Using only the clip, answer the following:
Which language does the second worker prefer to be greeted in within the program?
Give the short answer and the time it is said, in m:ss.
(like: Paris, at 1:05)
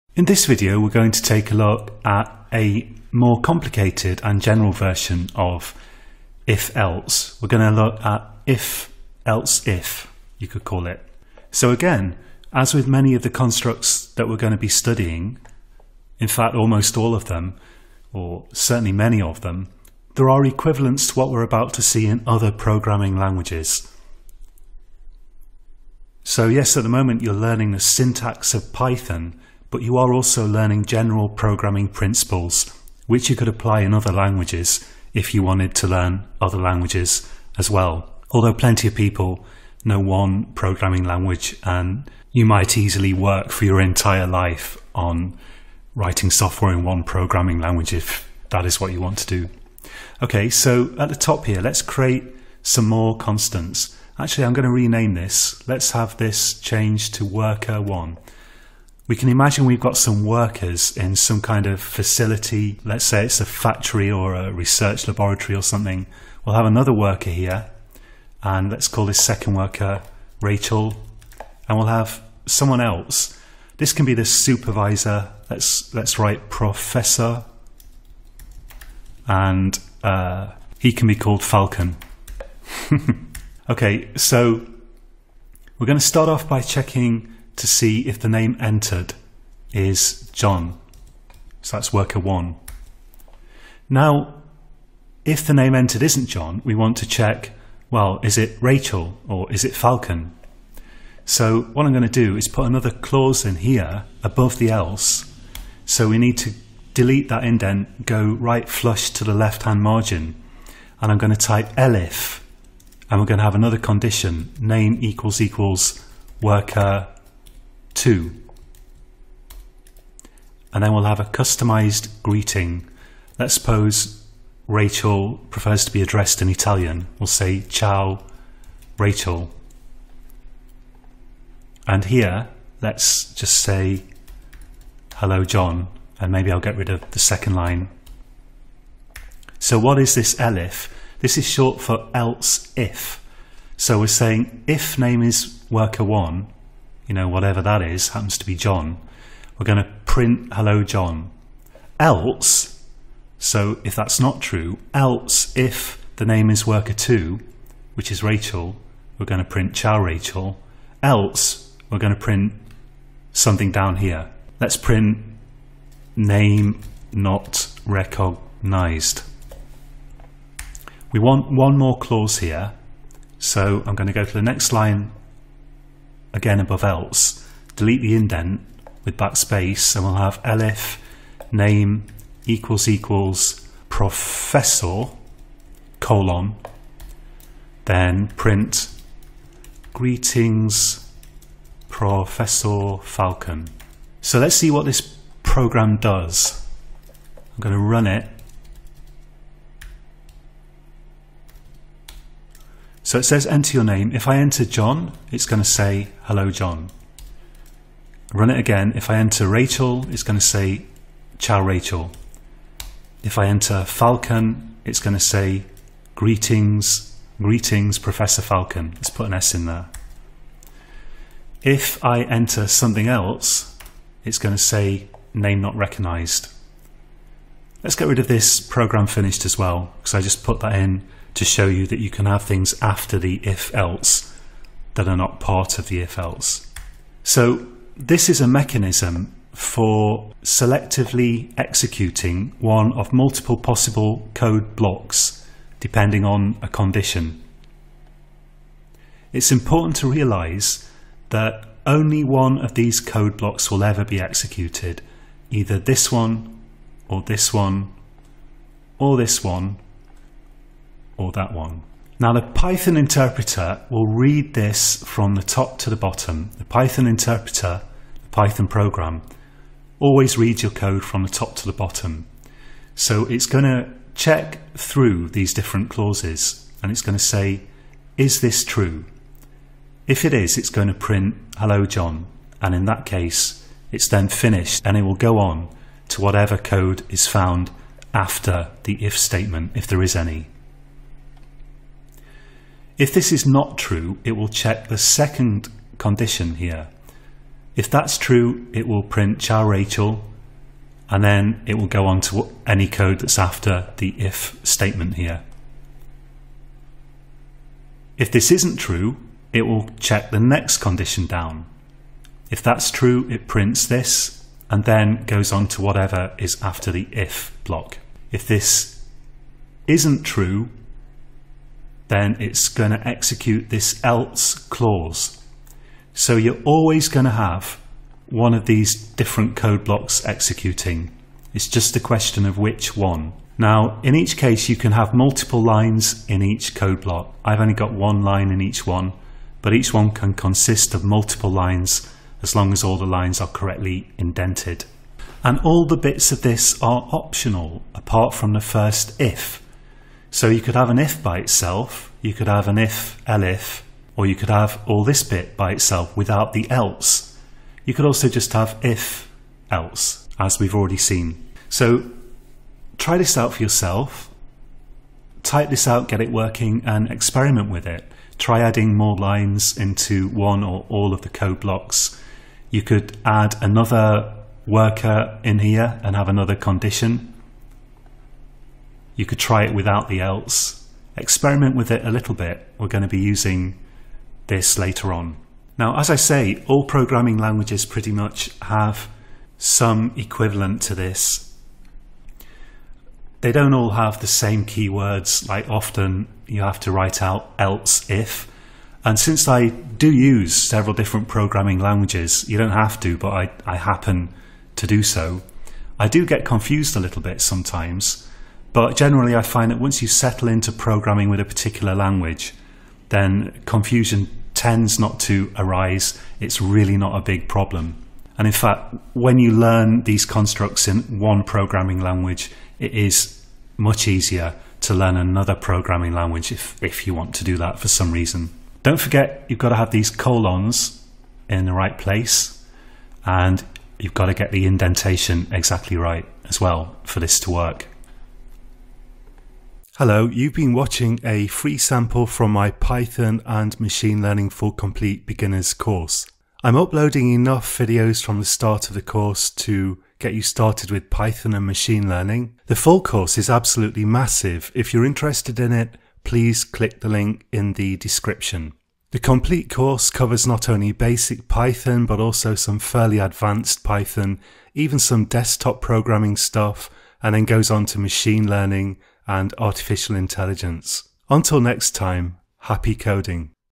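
Italian, at 2:06.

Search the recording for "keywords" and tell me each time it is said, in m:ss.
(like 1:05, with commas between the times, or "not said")
6:34.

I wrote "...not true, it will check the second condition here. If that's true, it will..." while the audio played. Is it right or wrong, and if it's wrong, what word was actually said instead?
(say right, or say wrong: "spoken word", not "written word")
right.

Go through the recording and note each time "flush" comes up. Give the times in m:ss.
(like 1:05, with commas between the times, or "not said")
1:48.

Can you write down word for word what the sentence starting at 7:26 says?
I'm uploading enough videos from the start of the course to get you started with Python and machine learning.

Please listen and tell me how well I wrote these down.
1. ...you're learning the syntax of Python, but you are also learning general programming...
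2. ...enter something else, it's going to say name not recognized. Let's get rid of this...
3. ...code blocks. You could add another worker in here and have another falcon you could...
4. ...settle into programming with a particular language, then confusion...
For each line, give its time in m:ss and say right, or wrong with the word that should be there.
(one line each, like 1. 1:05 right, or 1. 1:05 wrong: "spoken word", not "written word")
1. 0:27 right
2. 3:42 right
3. 6:11 wrong: "condition", not "falcon"
4. 6:50 right.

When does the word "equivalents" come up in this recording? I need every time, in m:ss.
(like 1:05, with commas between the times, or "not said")
0:20, 6:30.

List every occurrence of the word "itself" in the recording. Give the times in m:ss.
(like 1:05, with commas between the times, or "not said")
5:51, 5:55.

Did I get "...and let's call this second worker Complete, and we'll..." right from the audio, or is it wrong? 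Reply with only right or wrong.
wrong.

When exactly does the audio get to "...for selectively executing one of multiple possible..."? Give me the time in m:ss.
3:59.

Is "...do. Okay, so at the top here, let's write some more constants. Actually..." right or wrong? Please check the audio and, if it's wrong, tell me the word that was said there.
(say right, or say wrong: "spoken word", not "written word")
wrong: "create", not "write".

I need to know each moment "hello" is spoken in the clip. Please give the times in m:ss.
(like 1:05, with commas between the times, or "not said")
2:15, 2:30, 3:26, 4:41, 7:20.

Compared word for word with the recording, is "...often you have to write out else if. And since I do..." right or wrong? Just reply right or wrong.
right.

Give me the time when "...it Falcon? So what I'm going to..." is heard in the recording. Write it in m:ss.
1:39.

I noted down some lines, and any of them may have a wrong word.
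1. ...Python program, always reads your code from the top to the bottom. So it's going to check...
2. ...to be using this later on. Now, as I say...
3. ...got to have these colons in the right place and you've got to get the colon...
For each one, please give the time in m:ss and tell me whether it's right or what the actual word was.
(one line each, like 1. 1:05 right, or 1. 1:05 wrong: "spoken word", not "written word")
1. 4:28 right
2. 6:23 right
3. 7:09 wrong: "indentation", not "colon".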